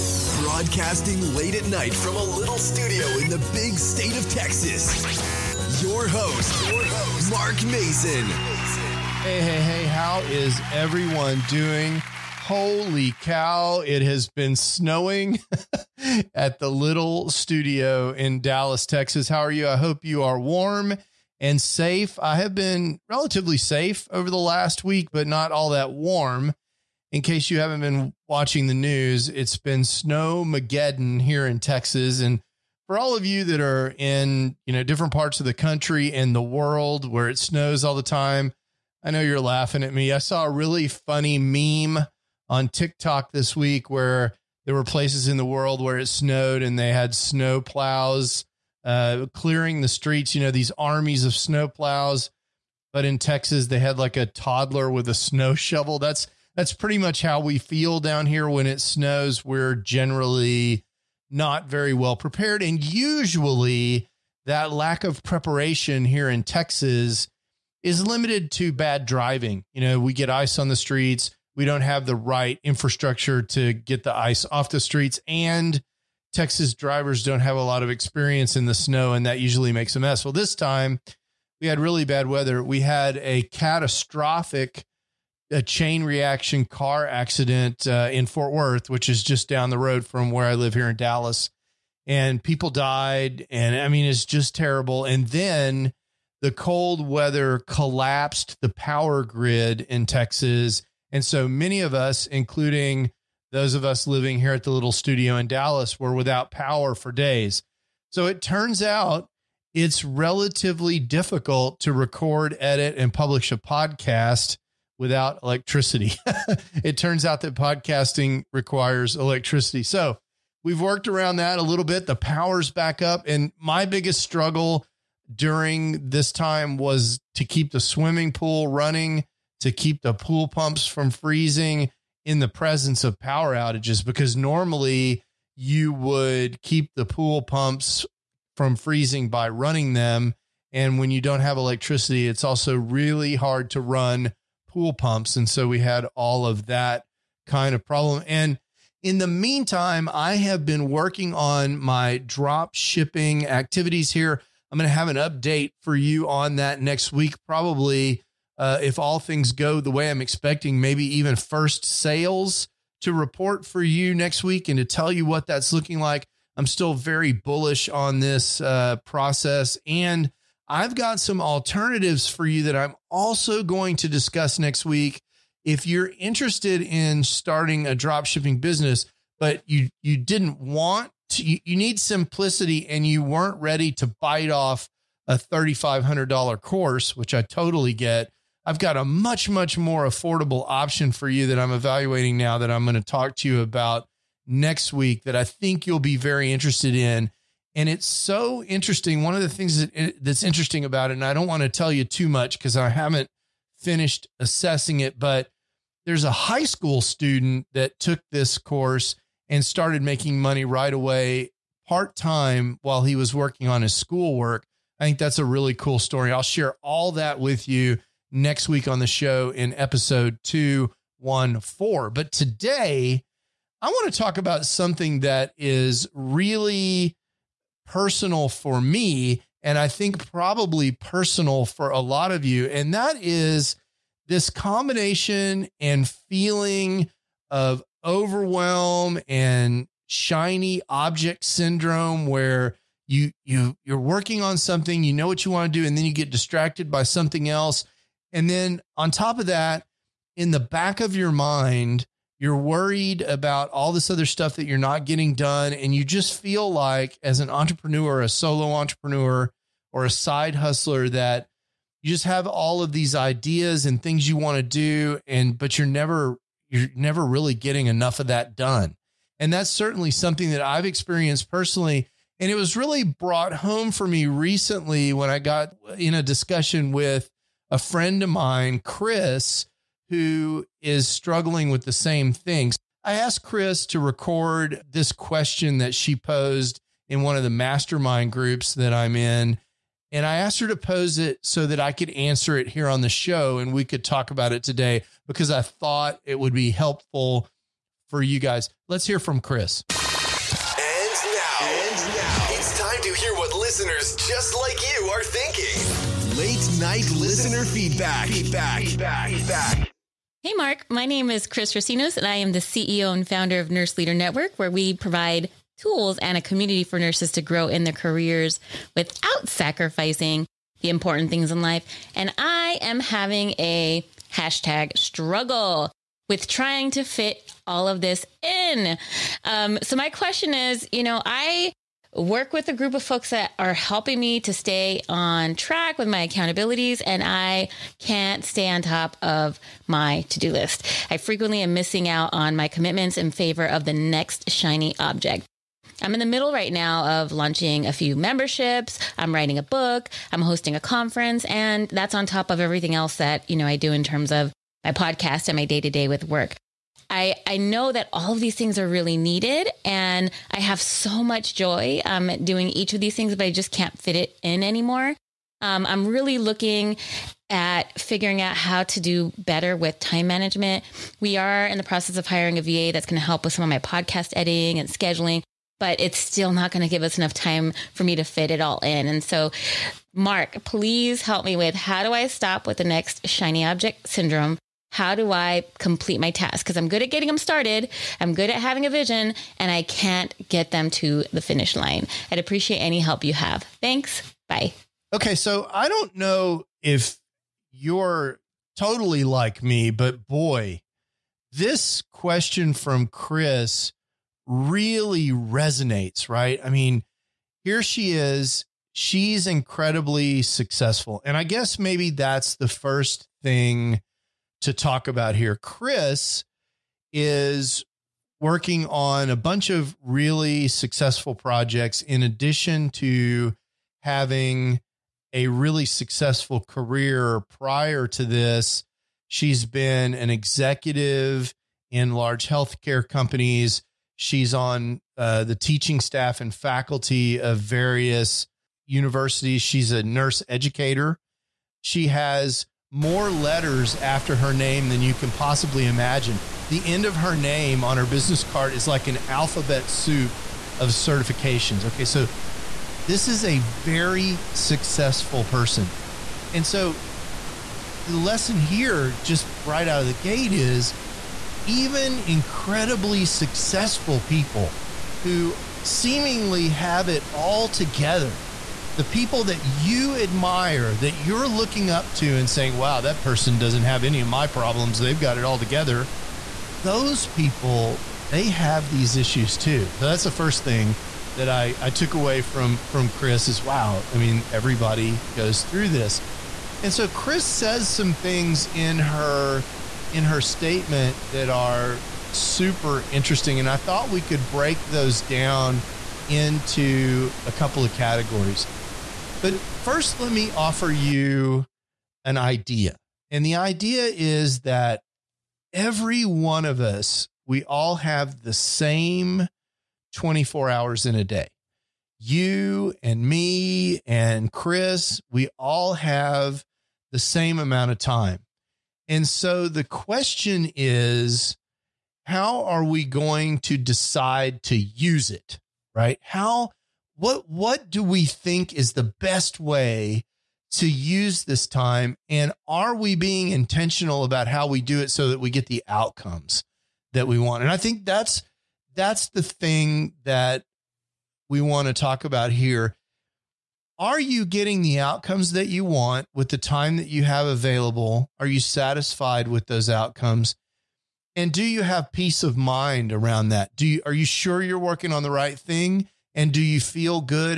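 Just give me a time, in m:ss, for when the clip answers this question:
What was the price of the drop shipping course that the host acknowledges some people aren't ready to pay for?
3:05.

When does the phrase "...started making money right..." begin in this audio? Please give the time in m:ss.
3:29.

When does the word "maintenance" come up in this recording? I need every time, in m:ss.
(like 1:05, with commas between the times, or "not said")
not said.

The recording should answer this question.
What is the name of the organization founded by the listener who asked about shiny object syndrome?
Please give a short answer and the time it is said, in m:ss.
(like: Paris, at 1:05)
Nurse Leader Network, at 5:13.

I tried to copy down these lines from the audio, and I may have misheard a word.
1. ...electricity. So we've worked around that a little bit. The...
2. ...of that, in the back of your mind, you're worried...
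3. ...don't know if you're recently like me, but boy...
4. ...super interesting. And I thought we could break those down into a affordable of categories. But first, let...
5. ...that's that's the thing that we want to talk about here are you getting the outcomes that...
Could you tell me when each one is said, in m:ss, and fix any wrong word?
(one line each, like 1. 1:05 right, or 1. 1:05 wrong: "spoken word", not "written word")
1. 1:59 right
2. 4:09 right
3. 6:35 wrong: "totally", not "recently"
4. 8:12 wrong: "couple", not "affordable"
5. 8:58 right.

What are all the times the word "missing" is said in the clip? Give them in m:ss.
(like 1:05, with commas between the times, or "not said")
5:41.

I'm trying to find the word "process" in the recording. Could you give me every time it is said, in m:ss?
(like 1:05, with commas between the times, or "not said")
2:49, 6:11.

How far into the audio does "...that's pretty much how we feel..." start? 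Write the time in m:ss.
0:56.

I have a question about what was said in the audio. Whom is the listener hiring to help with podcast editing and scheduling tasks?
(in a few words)
a VA.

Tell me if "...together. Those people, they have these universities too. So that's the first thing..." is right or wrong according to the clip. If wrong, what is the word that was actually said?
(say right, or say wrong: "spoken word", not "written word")
wrong: "issues", not "universities".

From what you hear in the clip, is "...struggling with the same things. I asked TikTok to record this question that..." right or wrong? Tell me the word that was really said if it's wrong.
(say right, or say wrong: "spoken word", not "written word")
wrong: "Chris", not "TikTok".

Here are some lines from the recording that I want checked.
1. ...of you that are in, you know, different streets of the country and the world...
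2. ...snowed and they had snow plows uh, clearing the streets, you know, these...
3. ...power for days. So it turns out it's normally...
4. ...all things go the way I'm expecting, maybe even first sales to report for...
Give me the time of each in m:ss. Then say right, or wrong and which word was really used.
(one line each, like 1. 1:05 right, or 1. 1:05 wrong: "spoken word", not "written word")
1. 0:33 wrong: "parts", not "streets"
2. 0:46 right
3. 1:46 wrong: "relatively", not "normally"
4. 2:38 right.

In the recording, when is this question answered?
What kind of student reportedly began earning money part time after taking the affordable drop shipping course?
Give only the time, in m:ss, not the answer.
3:26.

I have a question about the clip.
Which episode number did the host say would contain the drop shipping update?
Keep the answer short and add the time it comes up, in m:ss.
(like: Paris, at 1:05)
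214, at 3:39.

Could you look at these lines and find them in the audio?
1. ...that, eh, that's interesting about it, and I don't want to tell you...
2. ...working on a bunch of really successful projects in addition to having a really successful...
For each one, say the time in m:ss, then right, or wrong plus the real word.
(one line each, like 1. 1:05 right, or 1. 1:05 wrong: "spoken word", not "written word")
1. 3:19 right
2. 6:58 right.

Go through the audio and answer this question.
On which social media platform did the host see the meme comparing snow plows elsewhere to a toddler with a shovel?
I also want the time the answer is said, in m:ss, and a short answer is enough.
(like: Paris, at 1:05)
TikTok, at 0:42.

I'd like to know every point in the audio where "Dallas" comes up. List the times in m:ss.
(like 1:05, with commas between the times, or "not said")
0:18, 1:30, 1:45.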